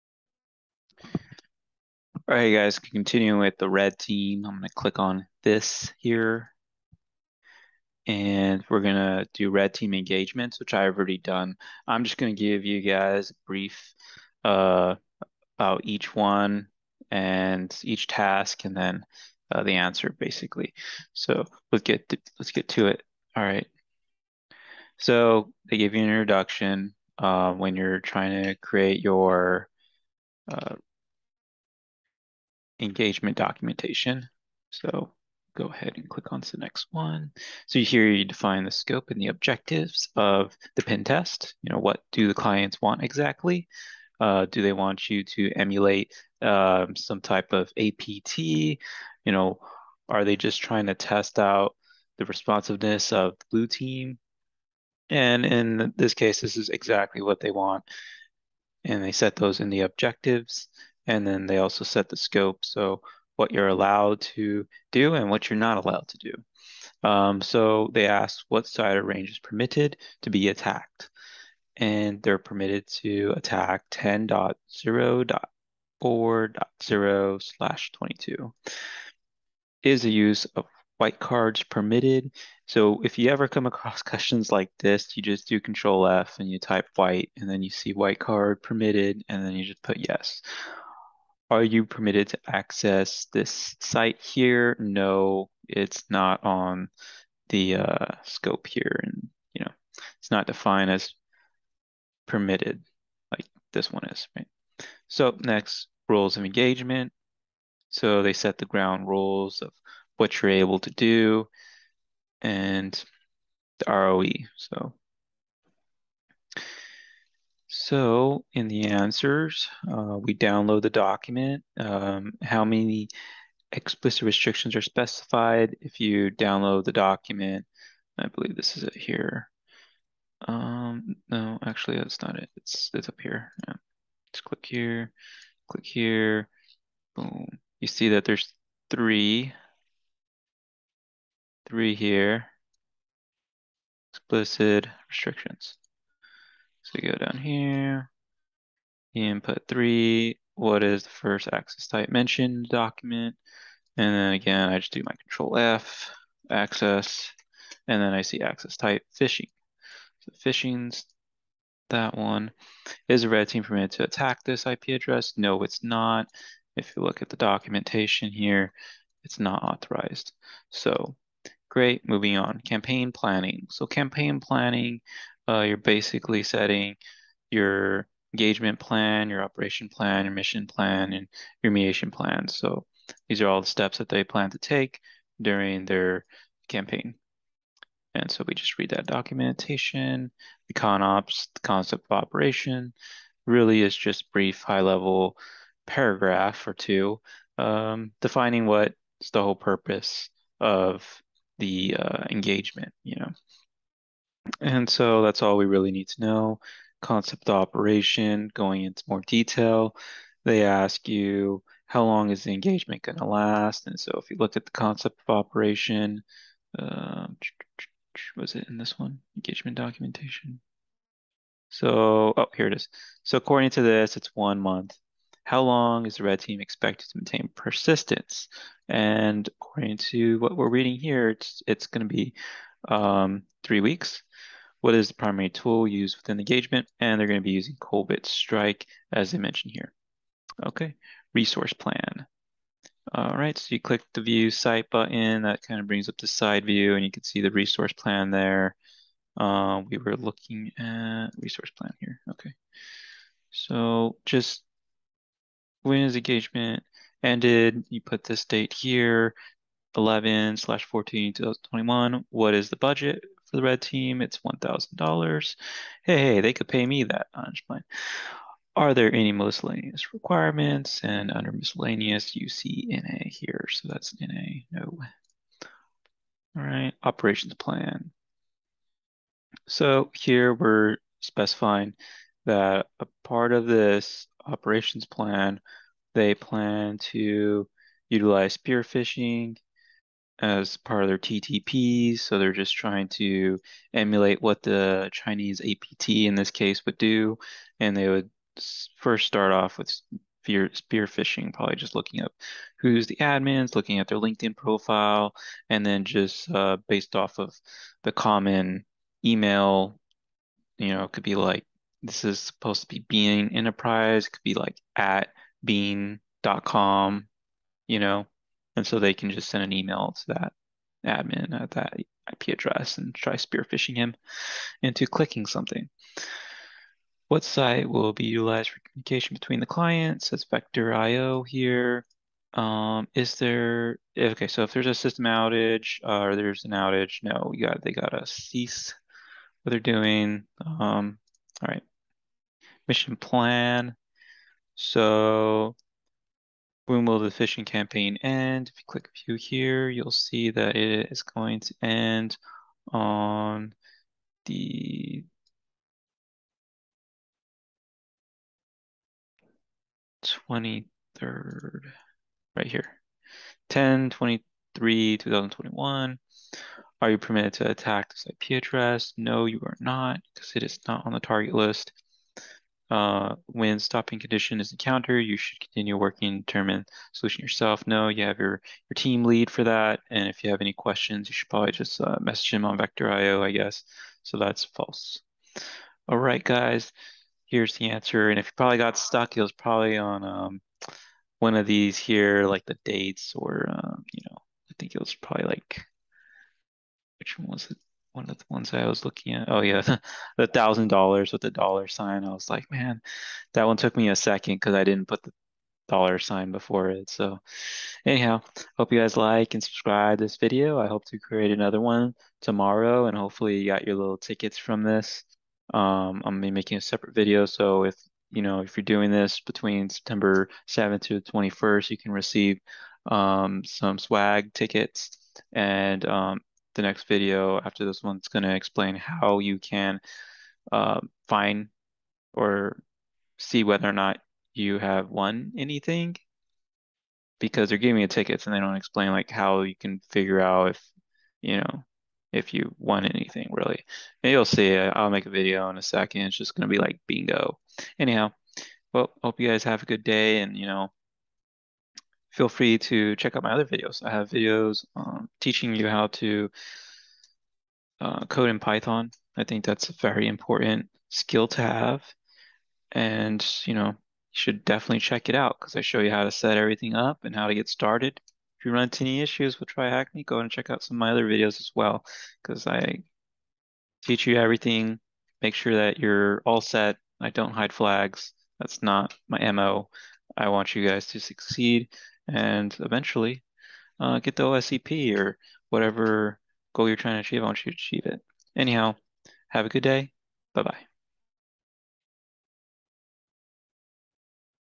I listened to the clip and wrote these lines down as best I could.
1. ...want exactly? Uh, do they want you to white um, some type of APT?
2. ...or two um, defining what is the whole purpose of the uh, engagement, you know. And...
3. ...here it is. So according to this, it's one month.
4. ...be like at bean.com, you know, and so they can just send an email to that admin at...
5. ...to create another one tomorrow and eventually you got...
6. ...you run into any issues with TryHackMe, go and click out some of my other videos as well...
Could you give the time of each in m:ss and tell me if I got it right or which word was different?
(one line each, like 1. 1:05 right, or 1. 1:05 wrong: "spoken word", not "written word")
1. 0:42 wrong: "emulate", not "white"
2. 3:16 right
3. 3:42 right
4. 5:14 right
5. 6:51 wrong: "hopefully", not "eventually"
6. 7:48 wrong: "check", not "click".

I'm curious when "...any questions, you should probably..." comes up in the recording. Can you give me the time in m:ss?
6:20.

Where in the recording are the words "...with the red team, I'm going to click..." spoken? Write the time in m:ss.
0:03.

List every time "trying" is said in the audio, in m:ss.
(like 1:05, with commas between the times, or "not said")
0:27, 0:50, 4:52, 8:06.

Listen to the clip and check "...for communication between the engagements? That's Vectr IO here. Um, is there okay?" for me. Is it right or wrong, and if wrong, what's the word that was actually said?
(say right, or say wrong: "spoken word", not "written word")
wrong: "clients", not "engagements".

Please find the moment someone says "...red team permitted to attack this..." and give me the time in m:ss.
2:43.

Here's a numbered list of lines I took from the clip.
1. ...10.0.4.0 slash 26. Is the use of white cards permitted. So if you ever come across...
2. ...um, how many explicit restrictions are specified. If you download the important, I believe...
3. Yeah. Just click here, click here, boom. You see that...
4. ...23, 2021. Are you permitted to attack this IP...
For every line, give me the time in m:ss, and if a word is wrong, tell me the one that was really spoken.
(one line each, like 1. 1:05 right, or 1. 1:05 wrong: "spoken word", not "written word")
1. 1:13 wrong: "22", not "26"
2. 2:01 wrong: "document", not "important"
3. 2:13 right
4. 6:04 right.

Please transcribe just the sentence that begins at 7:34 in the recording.
I have videos um, teaching you how to uh, code in Python.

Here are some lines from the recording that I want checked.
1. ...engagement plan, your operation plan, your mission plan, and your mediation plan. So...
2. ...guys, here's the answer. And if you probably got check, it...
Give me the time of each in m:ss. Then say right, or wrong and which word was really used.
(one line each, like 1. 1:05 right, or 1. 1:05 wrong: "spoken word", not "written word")
1. 2:58 right
2. 6:26 wrong: "stuck", not "check".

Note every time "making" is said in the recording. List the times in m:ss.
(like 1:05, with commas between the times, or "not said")
6:56.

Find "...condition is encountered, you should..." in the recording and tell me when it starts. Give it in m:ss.
6:14.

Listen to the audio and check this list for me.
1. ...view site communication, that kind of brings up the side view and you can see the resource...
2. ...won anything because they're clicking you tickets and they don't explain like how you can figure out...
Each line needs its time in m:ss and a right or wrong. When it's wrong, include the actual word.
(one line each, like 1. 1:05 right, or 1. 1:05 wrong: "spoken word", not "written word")
1. 4:04 wrong: "button", not "communication"
2. 7:15 wrong: "giving", not "clicking".